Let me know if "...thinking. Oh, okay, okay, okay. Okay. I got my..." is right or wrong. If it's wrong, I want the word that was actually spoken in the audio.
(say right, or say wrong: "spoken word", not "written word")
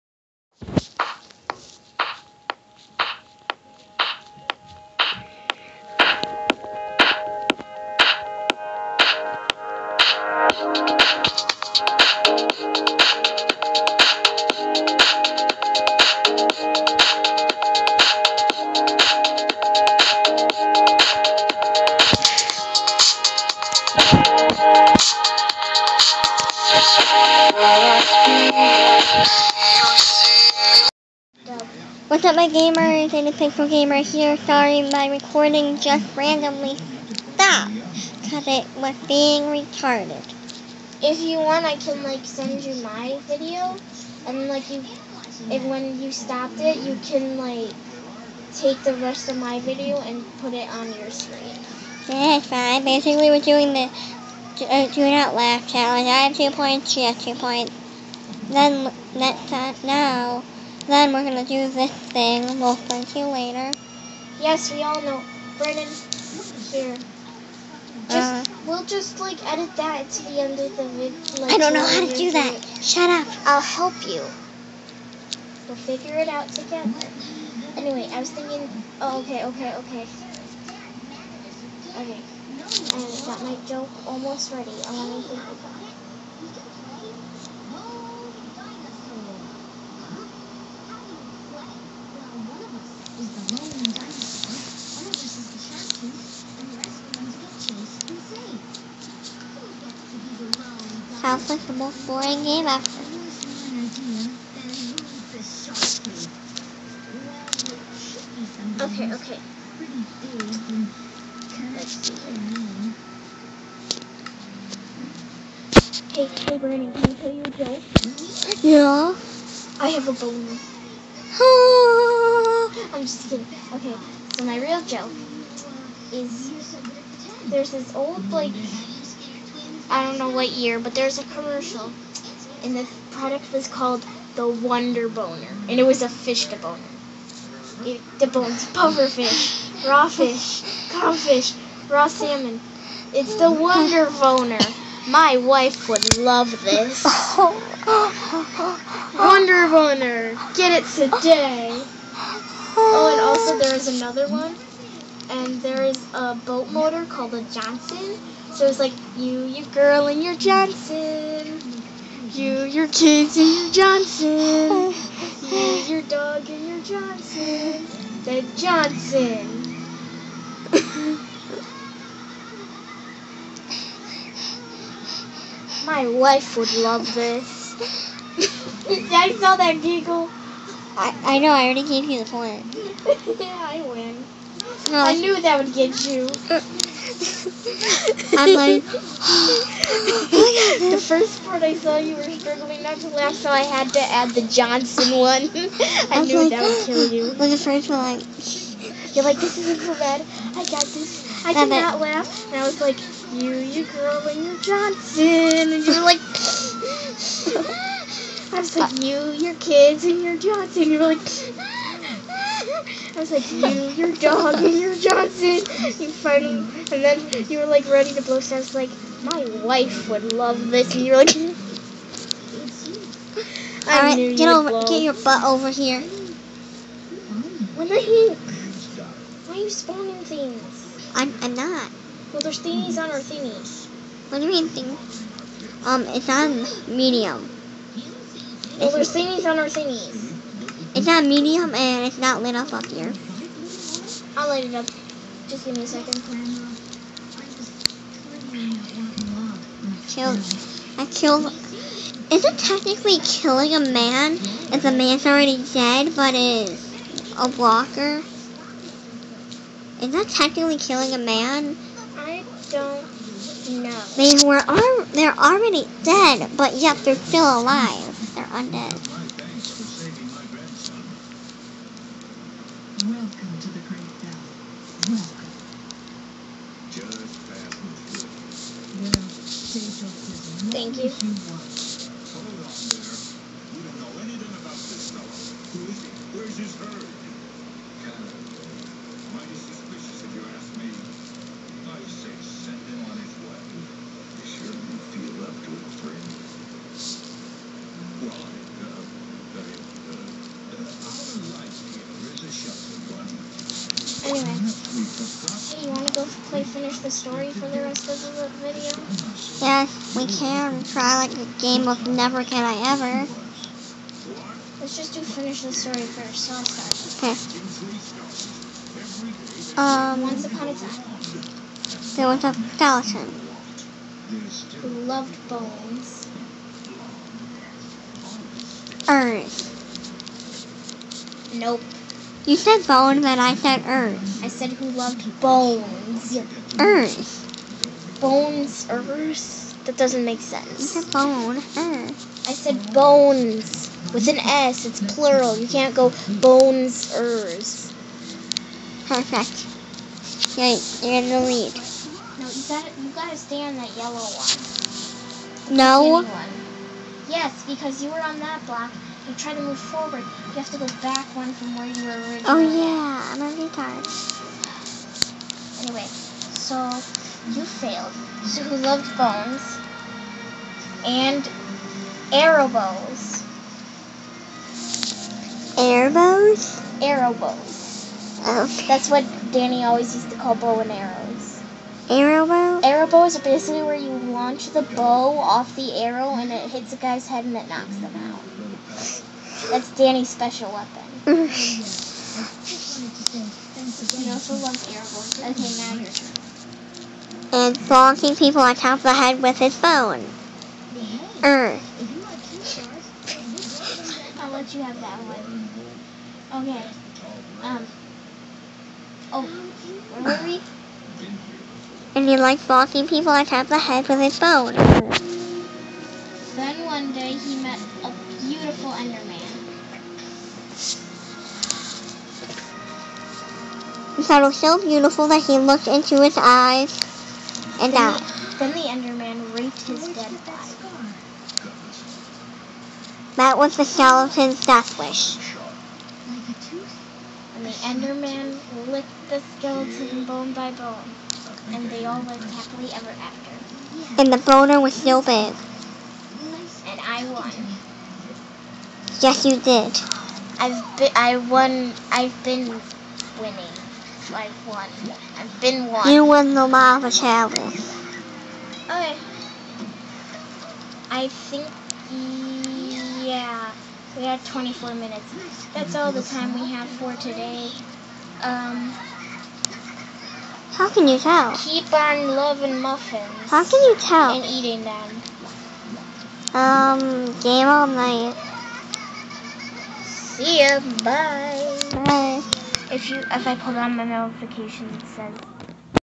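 right.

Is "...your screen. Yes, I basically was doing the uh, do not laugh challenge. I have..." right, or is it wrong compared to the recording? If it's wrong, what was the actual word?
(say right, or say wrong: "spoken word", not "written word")
right.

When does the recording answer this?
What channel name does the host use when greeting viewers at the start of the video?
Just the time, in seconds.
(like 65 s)
33 s.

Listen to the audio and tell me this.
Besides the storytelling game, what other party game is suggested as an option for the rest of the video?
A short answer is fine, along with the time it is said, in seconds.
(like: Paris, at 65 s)
Never Can I Ever, at 312 s.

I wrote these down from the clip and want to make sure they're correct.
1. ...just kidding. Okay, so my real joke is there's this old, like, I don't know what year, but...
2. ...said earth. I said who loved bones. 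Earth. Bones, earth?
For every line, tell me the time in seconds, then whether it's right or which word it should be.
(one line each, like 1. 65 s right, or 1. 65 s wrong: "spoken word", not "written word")
1. 123 s right
2. 333 s right.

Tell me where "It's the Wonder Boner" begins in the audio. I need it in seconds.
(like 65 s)
143 s.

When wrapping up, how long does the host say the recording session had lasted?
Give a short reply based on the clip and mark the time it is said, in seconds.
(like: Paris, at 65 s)
24 minutes, at 464 s.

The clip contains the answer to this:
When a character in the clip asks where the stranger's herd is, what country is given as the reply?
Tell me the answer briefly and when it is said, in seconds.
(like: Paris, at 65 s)
Canada, at 288 s.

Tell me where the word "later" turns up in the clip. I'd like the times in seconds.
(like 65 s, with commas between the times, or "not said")
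63 s.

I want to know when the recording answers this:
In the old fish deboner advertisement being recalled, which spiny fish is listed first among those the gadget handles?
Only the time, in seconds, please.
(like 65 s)
138 s.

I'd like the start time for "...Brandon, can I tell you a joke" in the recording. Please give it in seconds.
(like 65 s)
116 s.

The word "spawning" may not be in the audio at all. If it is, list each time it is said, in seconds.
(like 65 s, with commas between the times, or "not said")
229 s.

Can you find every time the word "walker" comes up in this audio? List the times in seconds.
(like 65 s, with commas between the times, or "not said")
257 s.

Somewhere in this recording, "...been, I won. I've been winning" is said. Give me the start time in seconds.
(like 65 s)
450 s.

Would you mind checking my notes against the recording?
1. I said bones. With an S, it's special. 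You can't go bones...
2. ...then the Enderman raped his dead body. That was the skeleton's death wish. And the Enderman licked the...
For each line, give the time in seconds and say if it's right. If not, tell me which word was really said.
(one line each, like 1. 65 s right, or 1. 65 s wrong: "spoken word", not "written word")
1. 342 s wrong: "plural", not "special"
2. 428 s right.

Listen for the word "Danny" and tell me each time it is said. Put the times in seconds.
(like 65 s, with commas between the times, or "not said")
379 s, 389 s.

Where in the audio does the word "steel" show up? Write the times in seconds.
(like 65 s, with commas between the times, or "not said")
not said.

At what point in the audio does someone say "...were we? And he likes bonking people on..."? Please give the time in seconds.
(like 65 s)
410 s.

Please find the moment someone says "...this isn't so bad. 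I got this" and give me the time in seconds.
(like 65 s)
199 s.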